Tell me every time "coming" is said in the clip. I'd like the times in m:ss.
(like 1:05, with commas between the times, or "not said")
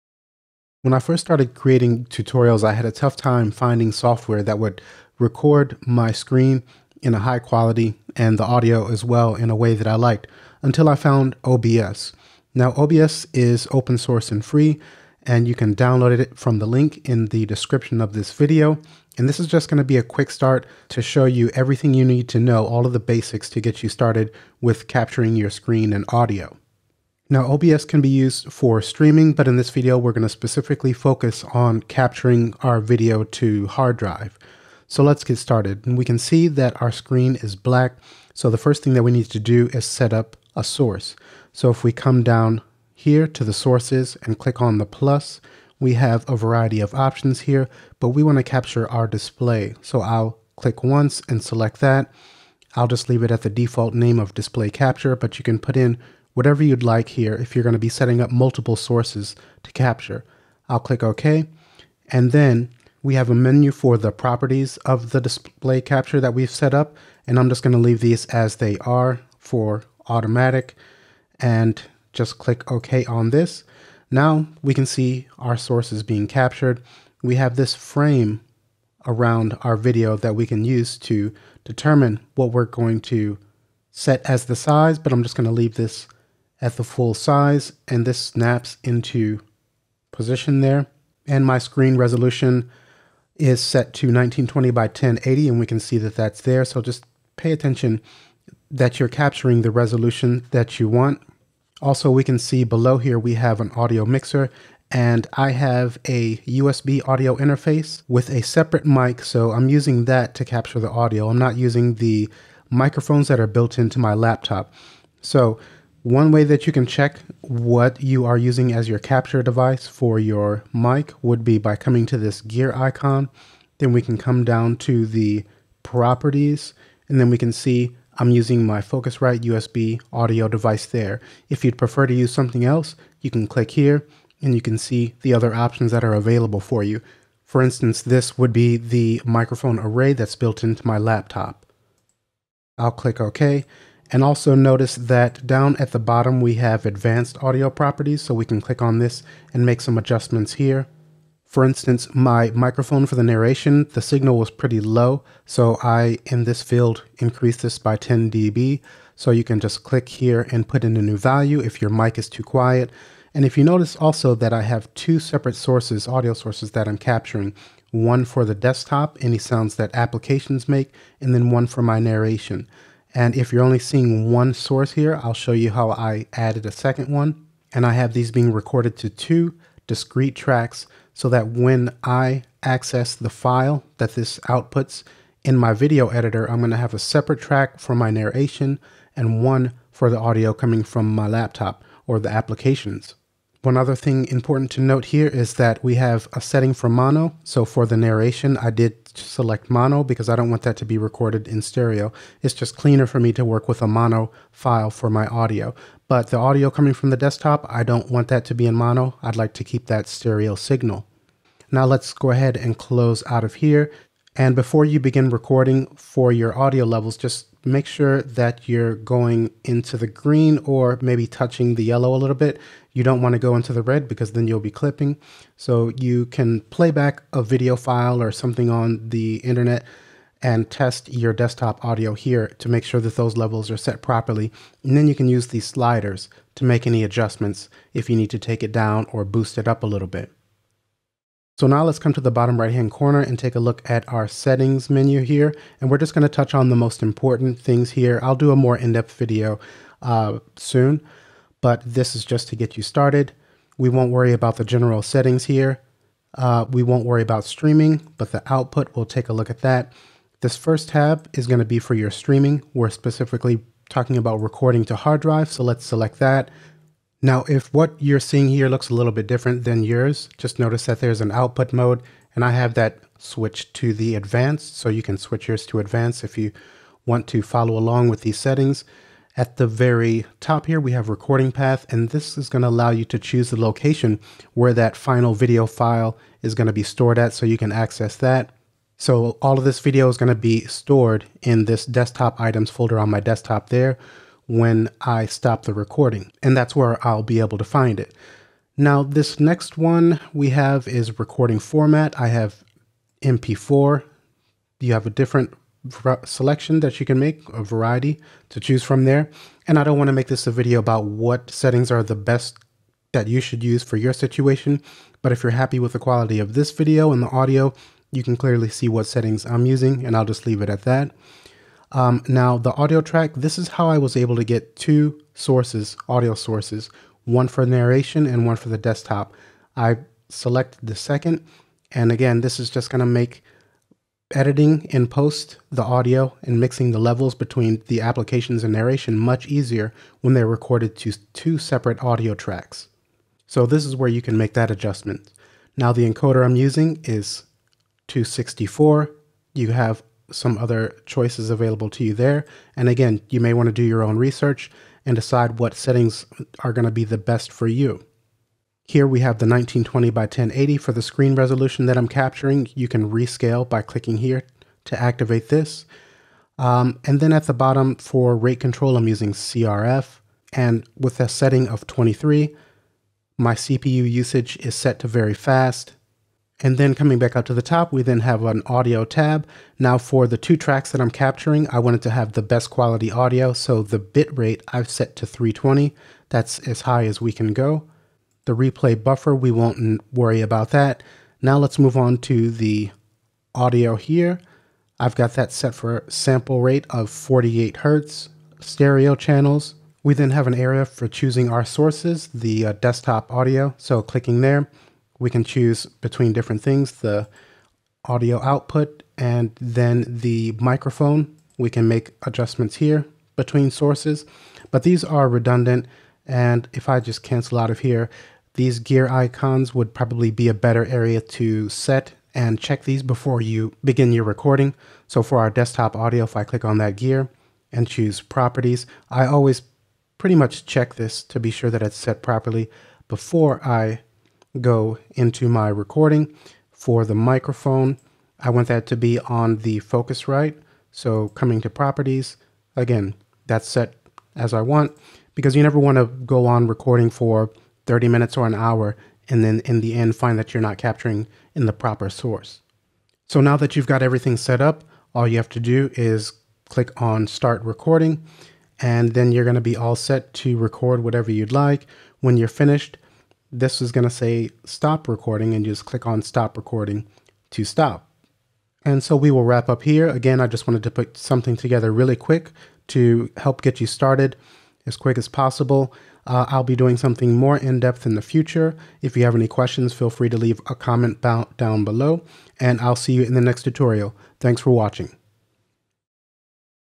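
2:01, 3:10, 3:26, 6:16, 7:21.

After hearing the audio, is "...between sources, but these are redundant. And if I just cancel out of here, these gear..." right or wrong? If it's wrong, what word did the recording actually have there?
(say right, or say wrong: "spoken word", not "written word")
right.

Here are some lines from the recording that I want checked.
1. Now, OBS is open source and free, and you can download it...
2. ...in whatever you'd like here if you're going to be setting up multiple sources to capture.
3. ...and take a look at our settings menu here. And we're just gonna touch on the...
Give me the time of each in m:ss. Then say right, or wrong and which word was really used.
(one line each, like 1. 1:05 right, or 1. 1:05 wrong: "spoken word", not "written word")
1. 0:12 right
2. 0:55 right
3. 4:03 right.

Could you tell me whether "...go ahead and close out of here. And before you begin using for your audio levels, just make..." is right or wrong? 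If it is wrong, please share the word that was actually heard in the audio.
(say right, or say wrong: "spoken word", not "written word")
wrong: "recording", not "using".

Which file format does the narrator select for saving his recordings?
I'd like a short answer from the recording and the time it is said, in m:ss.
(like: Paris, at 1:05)
MP4, at 5:03.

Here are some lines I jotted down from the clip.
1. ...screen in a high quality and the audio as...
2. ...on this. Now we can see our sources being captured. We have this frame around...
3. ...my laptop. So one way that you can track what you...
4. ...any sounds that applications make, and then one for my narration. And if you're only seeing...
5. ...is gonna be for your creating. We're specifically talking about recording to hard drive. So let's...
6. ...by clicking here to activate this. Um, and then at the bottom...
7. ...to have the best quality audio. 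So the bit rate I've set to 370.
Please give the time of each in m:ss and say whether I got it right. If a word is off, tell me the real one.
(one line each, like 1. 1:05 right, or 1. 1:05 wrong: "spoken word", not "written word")
1. 0:06 right
2. 1:13 right
3. 1:53 wrong: "check", not "track"
4. 2:49 right
5. 4:21 wrong: "streaming", not "creating"
6. 6:03 right
7. 6:22 wrong: "320", not "370".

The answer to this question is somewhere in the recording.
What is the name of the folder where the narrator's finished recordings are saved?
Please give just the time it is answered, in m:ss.
4:51.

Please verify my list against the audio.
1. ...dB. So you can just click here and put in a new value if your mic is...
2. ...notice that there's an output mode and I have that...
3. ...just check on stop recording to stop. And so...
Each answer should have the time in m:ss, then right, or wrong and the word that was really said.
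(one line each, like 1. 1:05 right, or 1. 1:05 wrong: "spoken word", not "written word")
1. 2:38 right
2. 4:30 right
3. 7:45 wrong: "click", not "check".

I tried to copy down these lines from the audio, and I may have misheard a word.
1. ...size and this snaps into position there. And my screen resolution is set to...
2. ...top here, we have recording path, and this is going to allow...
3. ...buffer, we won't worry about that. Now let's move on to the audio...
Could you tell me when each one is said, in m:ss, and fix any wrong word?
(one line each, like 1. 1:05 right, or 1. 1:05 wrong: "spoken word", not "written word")
1. 1:27 right
2. 4:40 right
3. 6:29 right.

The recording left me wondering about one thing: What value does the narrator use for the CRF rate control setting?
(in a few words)
23.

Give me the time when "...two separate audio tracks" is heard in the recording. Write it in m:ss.
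5:41.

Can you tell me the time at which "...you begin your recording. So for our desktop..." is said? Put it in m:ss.
7:03.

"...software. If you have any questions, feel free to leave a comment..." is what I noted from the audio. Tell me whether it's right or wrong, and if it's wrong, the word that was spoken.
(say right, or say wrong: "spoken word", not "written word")
wrong: "future", not "software".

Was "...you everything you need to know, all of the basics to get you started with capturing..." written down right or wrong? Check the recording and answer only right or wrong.
right.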